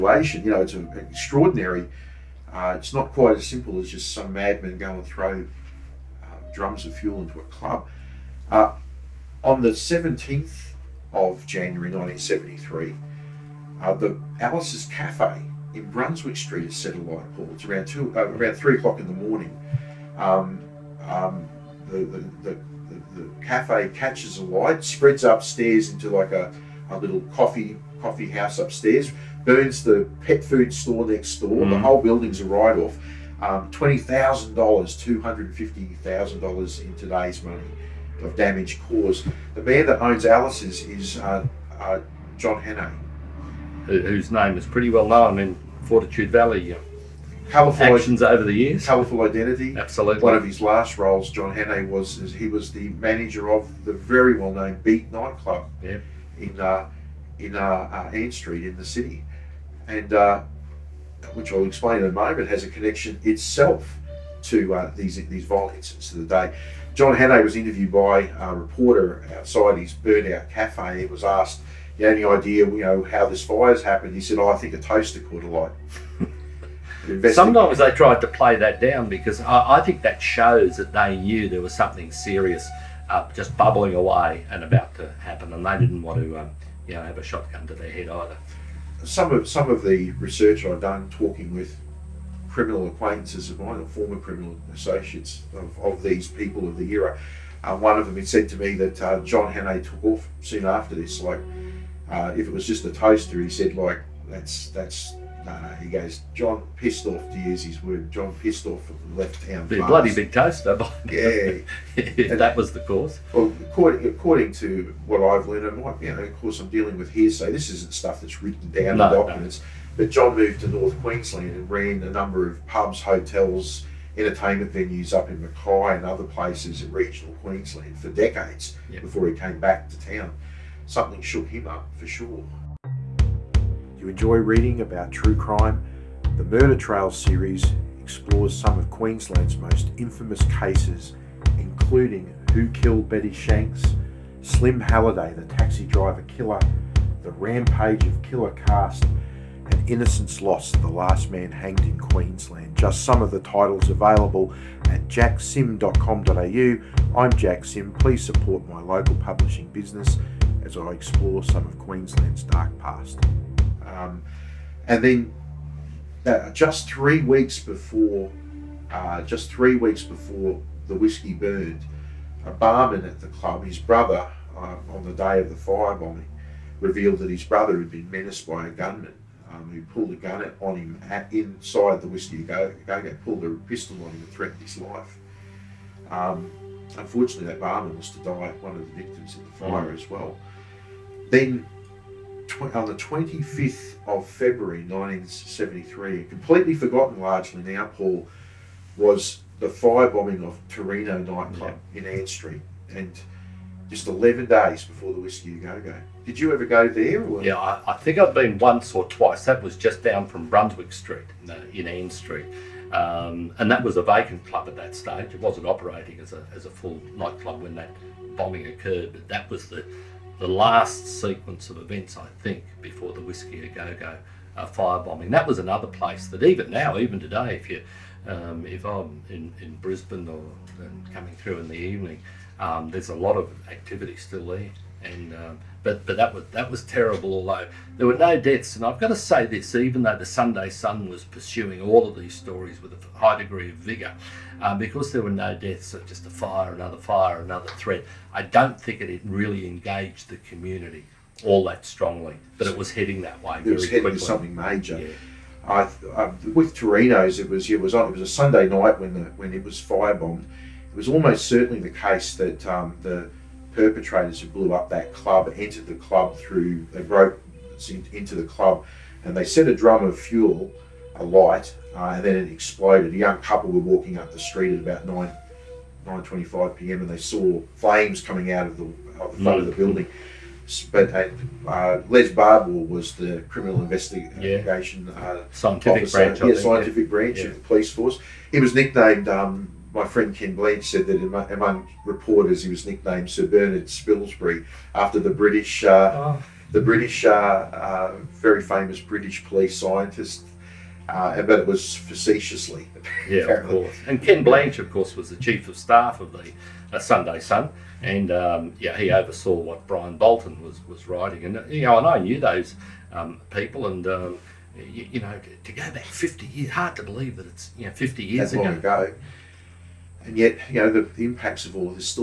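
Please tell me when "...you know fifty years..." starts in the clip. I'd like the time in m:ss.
5:17.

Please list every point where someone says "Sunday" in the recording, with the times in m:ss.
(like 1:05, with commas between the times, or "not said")
4:00, 4:18, 5:06.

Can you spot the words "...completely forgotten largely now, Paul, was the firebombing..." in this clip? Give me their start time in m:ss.
3:16.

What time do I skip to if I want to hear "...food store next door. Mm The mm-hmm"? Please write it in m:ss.
0:30.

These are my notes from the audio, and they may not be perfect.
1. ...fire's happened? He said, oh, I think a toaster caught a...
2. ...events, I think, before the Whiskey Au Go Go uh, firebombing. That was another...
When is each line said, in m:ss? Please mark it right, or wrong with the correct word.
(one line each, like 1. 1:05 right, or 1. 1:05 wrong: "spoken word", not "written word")
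1. 1:13 right
2. 3:41 right.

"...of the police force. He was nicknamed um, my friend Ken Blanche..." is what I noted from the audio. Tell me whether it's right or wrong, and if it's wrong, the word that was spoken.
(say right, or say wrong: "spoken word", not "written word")
right.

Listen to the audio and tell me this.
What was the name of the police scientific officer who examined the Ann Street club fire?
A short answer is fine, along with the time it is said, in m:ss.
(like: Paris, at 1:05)
Les Barbour, at 4:42.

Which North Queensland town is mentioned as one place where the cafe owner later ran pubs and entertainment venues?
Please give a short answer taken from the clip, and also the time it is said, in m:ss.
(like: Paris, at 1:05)
Mackay, at 2:05.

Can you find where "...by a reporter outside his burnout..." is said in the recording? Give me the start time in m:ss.
1:07.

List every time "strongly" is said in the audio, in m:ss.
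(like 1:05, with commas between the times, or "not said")
4:11.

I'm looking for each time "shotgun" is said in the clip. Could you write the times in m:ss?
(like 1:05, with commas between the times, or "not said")
1:27.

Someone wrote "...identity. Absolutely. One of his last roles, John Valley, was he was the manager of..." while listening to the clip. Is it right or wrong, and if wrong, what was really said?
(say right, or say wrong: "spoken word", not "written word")
wrong: "Hannay", not "Valley".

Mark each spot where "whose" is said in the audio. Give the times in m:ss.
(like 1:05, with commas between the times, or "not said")
0:43.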